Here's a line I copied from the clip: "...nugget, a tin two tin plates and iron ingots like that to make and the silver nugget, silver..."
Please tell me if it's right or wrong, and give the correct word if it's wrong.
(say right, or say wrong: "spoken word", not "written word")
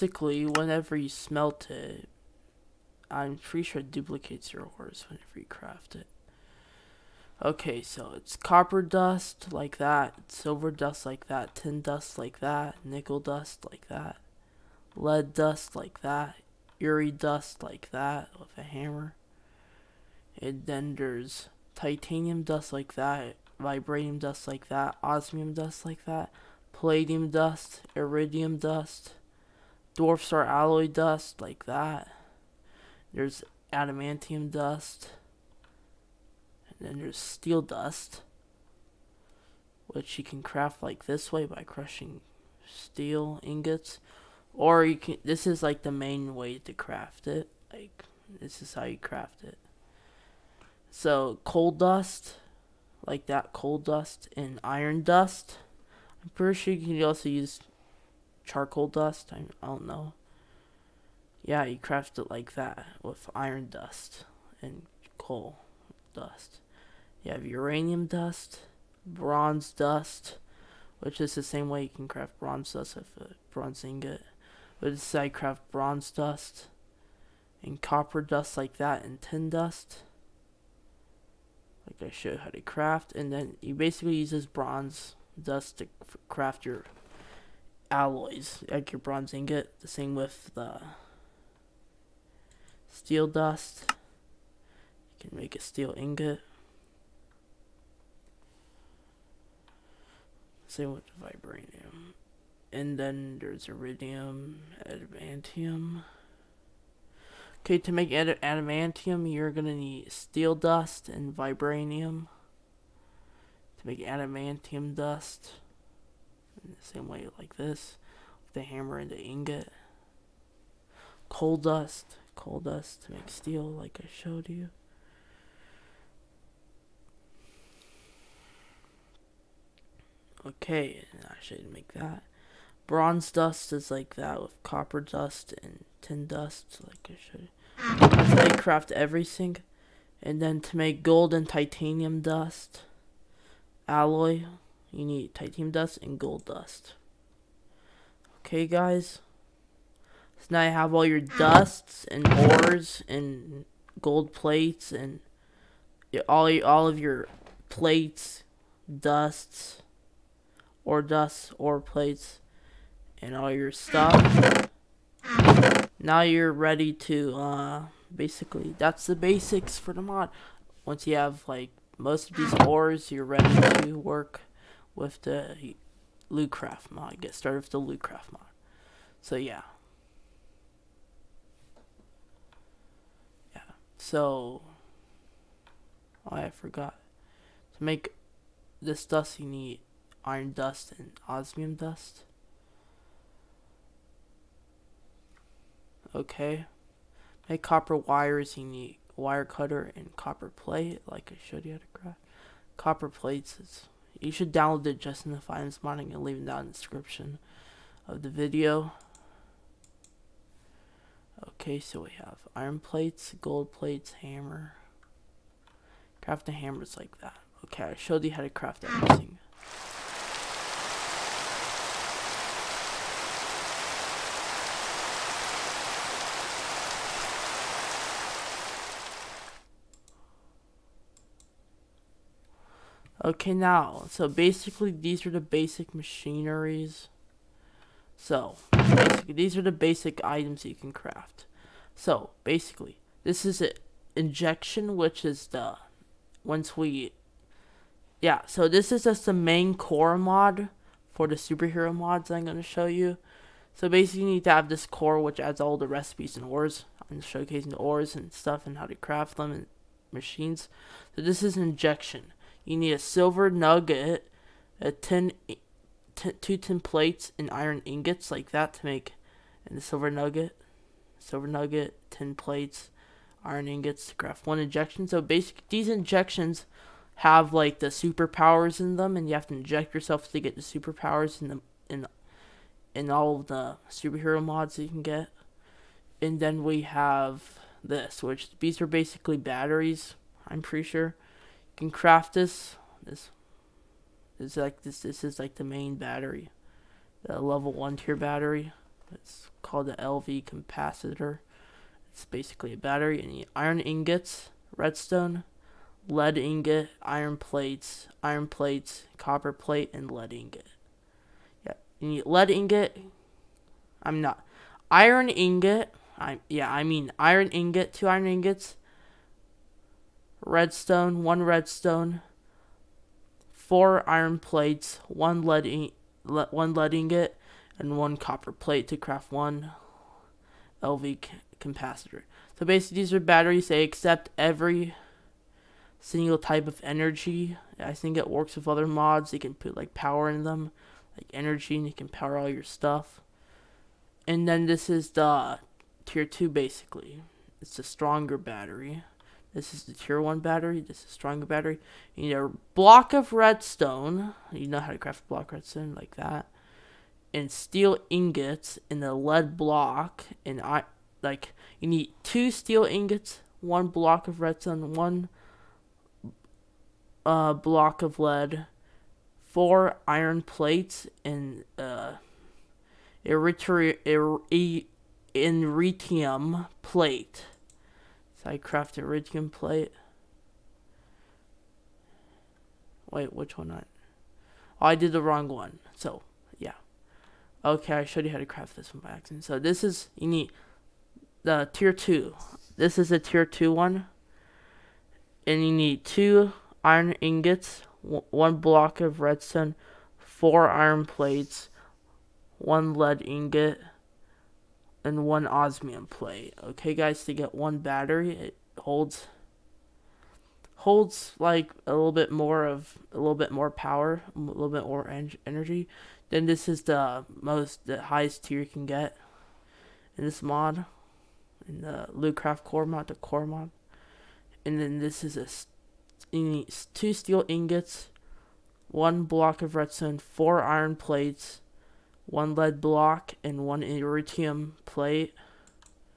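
right.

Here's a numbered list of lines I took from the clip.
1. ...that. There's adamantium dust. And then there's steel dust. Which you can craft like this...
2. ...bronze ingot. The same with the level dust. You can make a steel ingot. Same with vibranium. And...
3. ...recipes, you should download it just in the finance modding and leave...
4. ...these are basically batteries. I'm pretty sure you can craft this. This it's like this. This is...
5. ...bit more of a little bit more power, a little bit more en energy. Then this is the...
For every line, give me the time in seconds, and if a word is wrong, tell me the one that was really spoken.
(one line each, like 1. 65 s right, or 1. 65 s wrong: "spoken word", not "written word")
1. 31 s right
2. 88 s wrong: "steel", not "level"
3. 203 s wrong: "plates", not "recipes"
4. 288 s right
5. 412 s right.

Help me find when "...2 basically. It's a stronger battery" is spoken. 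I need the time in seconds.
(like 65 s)
346 s.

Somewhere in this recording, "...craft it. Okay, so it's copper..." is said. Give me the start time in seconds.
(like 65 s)
5 s.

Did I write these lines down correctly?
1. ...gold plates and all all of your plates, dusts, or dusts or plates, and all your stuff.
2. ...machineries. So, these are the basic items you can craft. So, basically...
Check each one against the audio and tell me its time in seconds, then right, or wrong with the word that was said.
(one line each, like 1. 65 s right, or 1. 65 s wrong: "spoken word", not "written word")
1. 153 s right
2. 235 s right.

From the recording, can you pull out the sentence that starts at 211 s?
Okay, so we have iron plates, gold plates, hammer.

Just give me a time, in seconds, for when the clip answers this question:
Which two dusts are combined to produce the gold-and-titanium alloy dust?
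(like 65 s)
145 s.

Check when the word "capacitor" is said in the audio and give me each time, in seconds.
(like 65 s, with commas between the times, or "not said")
300 s, 331 s.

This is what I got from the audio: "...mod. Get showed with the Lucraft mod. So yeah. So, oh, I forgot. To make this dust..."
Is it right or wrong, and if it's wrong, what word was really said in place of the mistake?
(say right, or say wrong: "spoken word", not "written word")
wrong: "started", not "showed".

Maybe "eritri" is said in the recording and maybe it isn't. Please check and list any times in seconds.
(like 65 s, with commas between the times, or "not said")
373 s.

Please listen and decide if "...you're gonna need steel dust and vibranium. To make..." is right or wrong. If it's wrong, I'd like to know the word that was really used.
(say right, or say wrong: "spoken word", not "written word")
right.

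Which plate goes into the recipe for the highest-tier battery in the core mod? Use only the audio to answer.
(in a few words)
Iridium plate.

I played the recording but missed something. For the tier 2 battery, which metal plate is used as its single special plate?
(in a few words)
Osmium plate.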